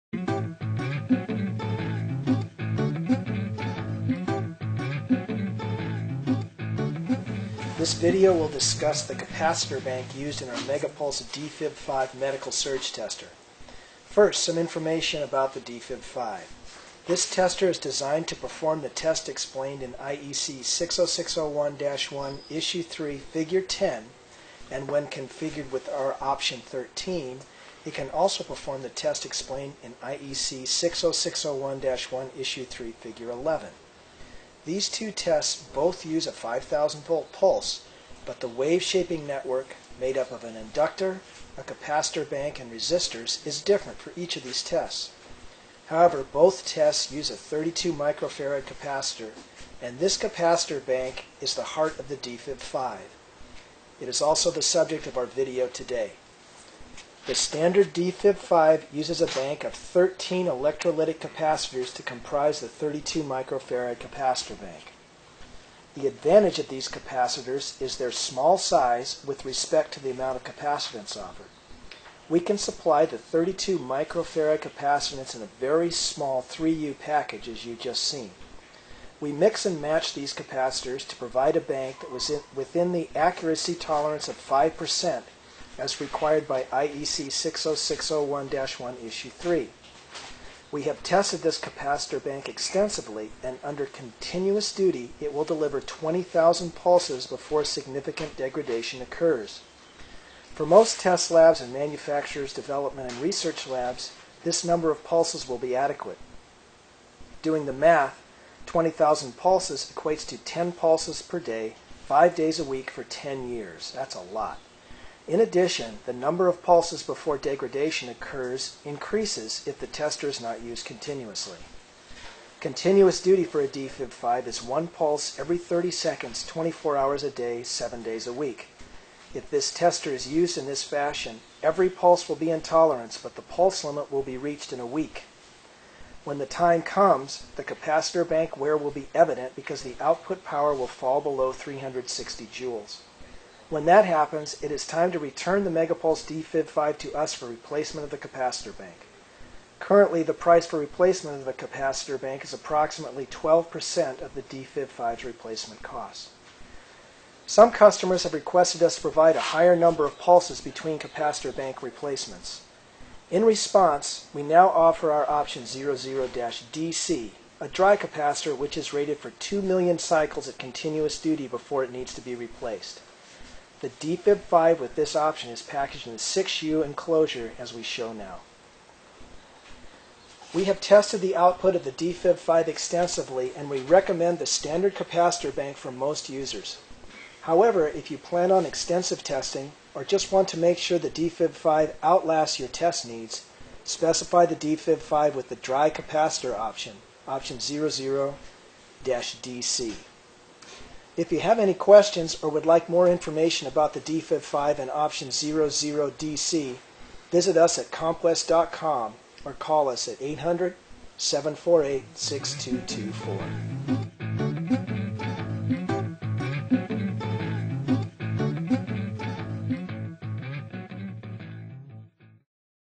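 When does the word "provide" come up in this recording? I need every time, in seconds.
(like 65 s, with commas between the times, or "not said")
81 s, 159 s.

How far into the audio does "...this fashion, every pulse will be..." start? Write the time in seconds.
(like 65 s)
130 s.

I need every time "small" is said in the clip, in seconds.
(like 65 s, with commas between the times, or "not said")
68 s, 75 s.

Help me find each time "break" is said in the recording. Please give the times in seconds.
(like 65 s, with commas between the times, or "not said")
not said.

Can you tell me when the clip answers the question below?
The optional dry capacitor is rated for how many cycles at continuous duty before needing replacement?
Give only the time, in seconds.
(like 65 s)
169 s.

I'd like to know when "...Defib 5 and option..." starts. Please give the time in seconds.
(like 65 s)
203 s.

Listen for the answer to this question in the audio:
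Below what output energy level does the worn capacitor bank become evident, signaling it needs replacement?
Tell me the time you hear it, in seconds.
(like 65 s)
141 s.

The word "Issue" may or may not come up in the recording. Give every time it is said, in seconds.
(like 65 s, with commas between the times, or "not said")
22 s, 32 s, 89 s.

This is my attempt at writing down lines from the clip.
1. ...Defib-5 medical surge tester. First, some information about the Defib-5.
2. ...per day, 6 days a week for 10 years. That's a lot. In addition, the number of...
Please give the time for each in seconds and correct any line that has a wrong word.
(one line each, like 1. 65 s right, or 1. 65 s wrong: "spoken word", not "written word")
1. 11 s right
2. 111 s wrong: "5", not "6".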